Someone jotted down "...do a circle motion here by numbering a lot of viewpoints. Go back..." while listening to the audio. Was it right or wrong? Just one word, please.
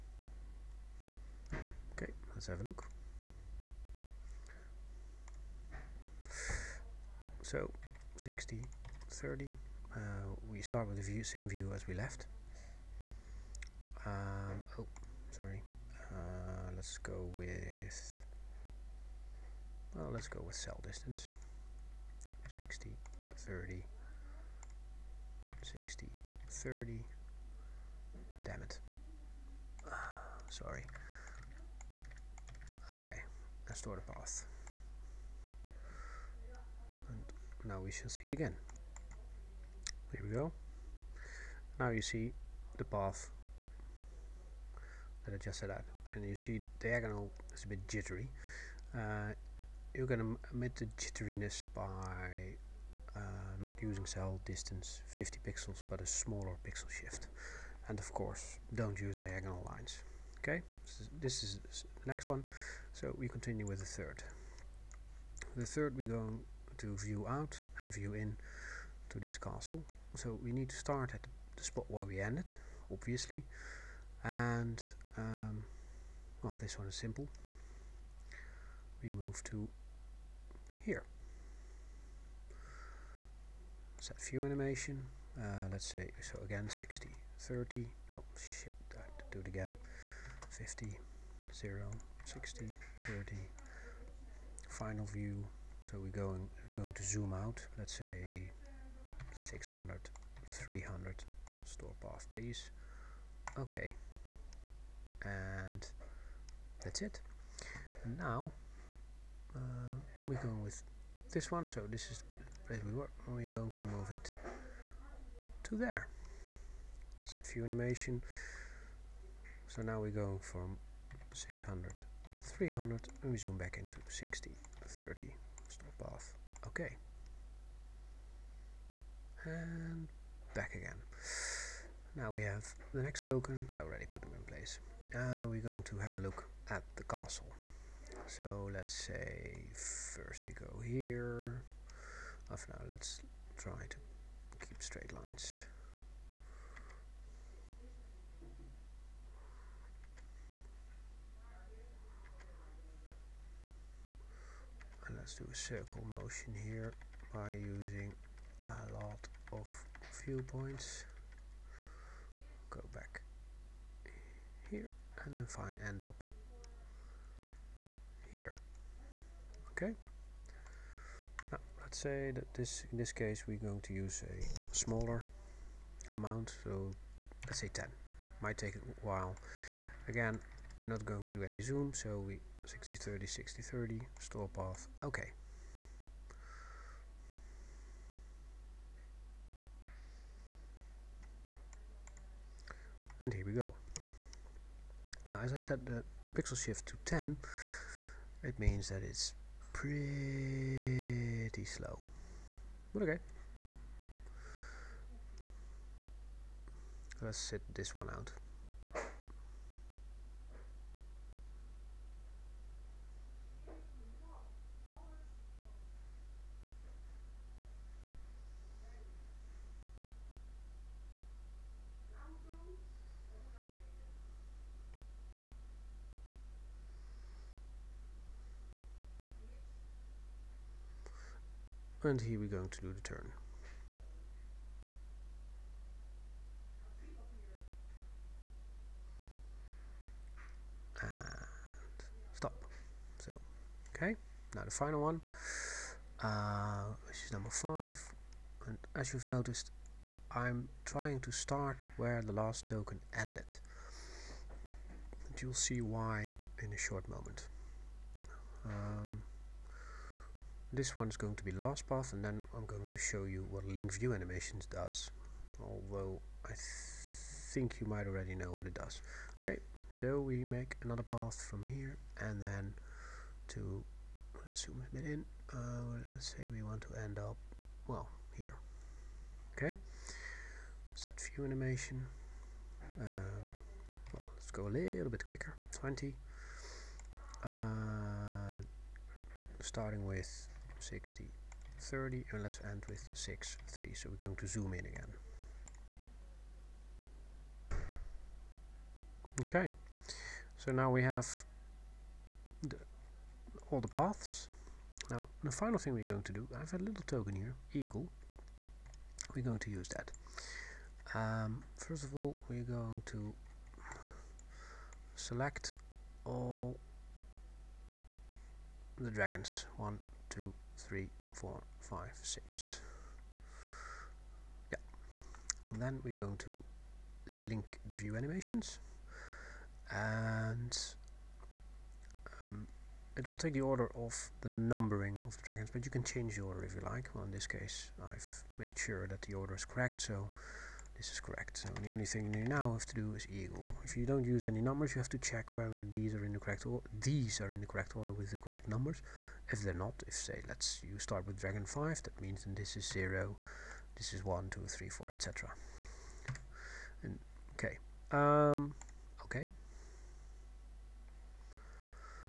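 wrong.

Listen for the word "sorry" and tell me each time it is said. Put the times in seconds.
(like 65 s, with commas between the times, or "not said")
15 s, 30 s.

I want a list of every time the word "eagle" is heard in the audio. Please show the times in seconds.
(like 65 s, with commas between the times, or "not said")
307 s, 343 s.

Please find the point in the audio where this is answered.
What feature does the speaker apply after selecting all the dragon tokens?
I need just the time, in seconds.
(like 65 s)
263 s.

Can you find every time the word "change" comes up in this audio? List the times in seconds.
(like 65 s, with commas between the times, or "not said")
336 s.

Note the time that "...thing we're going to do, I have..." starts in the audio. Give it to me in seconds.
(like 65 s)
305 s.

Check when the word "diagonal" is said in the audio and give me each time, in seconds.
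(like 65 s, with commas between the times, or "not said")
46 s, 59 s.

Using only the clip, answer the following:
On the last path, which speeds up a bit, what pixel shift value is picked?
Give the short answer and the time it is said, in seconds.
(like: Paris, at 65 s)
20, at 285 s.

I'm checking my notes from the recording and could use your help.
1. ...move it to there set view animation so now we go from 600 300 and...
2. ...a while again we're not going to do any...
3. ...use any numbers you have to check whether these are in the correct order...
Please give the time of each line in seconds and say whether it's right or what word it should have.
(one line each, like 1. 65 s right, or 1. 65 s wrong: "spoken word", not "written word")
1. 113 s right
2. 178 s right
3. 344 s right.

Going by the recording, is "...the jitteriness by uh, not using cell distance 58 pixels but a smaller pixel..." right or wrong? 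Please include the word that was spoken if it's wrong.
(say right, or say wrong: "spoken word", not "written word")
wrong: "50", not "58".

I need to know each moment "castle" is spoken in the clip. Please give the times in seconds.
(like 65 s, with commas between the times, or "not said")
69 s, 137 s.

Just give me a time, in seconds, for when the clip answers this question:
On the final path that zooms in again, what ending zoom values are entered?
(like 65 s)
293 s.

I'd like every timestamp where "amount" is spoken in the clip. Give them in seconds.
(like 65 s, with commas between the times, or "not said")
176 s.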